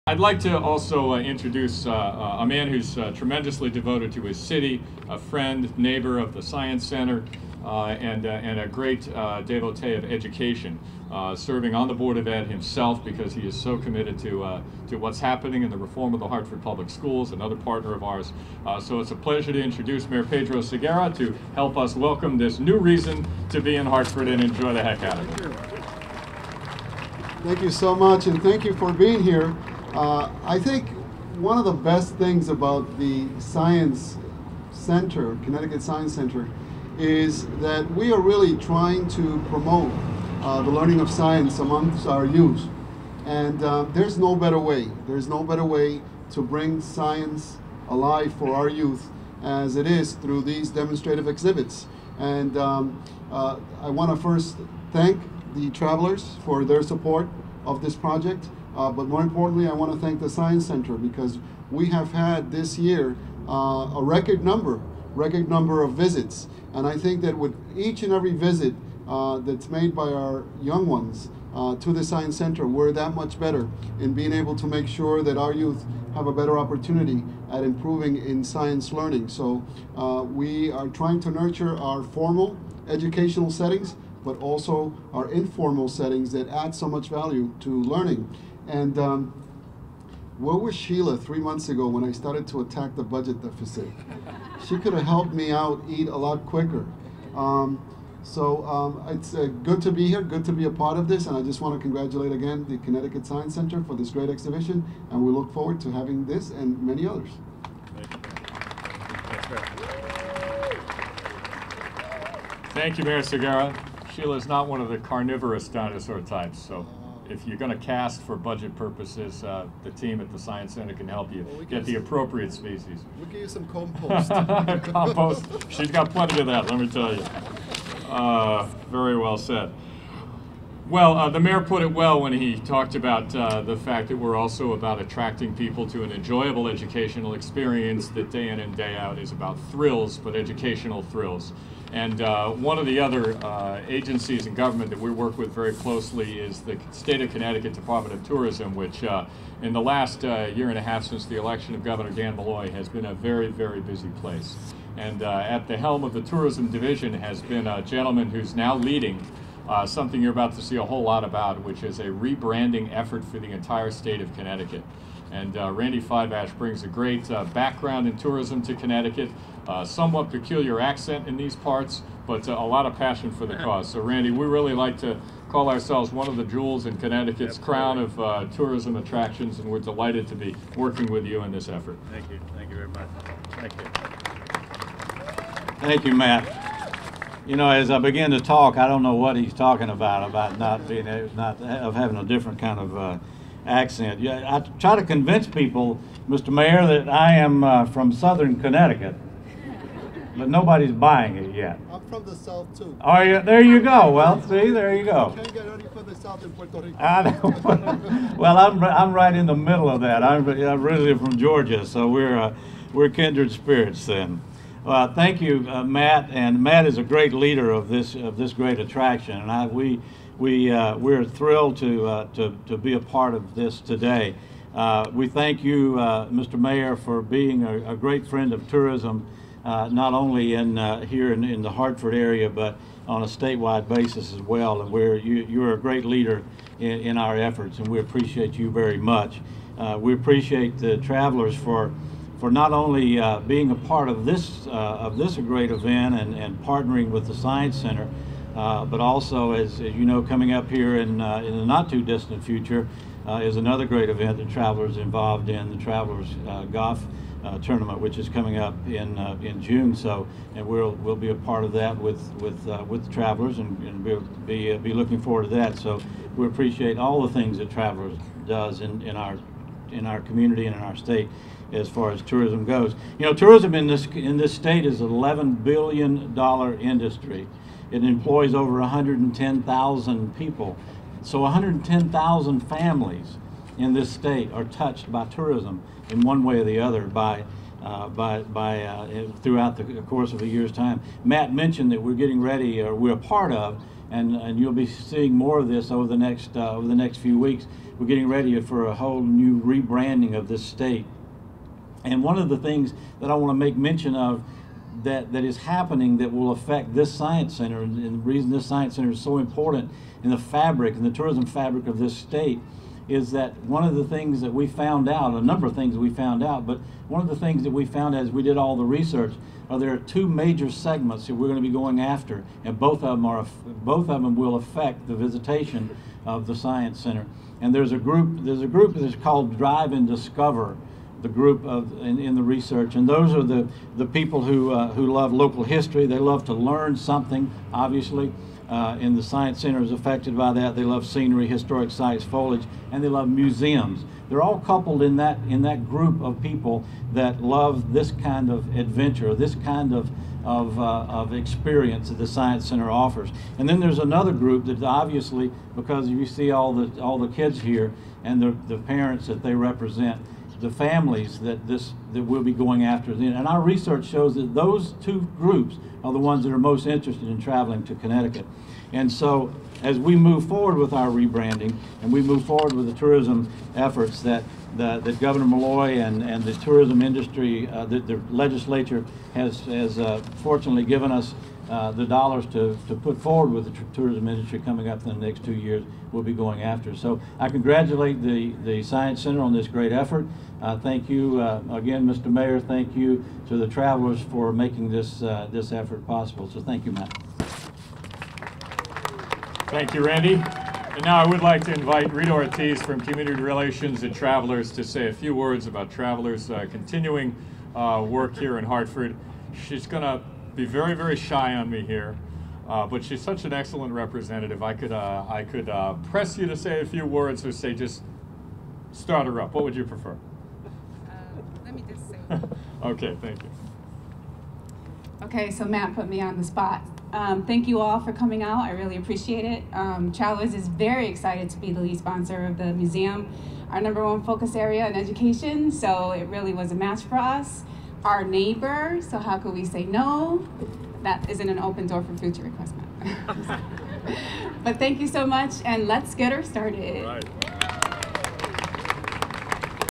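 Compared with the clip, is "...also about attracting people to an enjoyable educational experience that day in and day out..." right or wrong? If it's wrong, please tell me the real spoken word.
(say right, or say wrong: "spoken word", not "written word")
right.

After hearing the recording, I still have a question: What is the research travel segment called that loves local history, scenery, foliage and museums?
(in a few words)
Drive and discover.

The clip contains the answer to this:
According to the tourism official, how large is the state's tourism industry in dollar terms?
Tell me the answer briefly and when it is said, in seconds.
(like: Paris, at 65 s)
$11 billion, at 275 s.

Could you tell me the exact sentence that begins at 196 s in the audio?
Mayor, that I am uh, from Southern Connecticut, but nobody's buying it yet.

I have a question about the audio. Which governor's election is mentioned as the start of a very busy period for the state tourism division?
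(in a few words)
Dan Malloy.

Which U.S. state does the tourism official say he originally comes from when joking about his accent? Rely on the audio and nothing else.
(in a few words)
Georgia.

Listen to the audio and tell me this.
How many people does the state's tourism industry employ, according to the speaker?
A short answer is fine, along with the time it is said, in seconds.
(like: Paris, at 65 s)
Over 110,000, at 278 s.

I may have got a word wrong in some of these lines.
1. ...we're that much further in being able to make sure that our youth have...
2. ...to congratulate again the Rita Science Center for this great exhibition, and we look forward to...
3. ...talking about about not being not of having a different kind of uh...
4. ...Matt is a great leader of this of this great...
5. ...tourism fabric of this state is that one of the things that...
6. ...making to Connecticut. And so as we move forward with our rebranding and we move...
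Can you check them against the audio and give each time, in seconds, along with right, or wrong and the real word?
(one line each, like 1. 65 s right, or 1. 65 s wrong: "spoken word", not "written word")
1. 72 s wrong: "better", not "further"
2. 101 s wrong: "Connecticut", not "Rita"
3. 189 s right
4. 216 s right
5. 311 s right
6. 367 s wrong: "traveling", not "making".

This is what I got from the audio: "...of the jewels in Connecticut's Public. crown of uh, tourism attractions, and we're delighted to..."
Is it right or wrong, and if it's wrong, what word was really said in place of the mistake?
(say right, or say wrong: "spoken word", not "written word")
wrong: "Absolutely", not "Public".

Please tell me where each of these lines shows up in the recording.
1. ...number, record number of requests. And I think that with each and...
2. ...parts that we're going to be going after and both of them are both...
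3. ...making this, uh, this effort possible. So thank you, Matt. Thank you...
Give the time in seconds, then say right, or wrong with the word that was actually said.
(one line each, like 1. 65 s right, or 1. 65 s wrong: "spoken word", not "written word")
1. 64 s wrong: "visits", not "requests"
2. 320 s wrong: "segments", not "parts"
3. 394 s right.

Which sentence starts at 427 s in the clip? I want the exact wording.
Um, thank you all for coming out.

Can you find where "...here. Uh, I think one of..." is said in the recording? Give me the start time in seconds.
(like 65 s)
29 s.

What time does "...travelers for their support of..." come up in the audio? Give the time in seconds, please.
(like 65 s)
55 s.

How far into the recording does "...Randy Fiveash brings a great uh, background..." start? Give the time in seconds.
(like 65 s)
165 s.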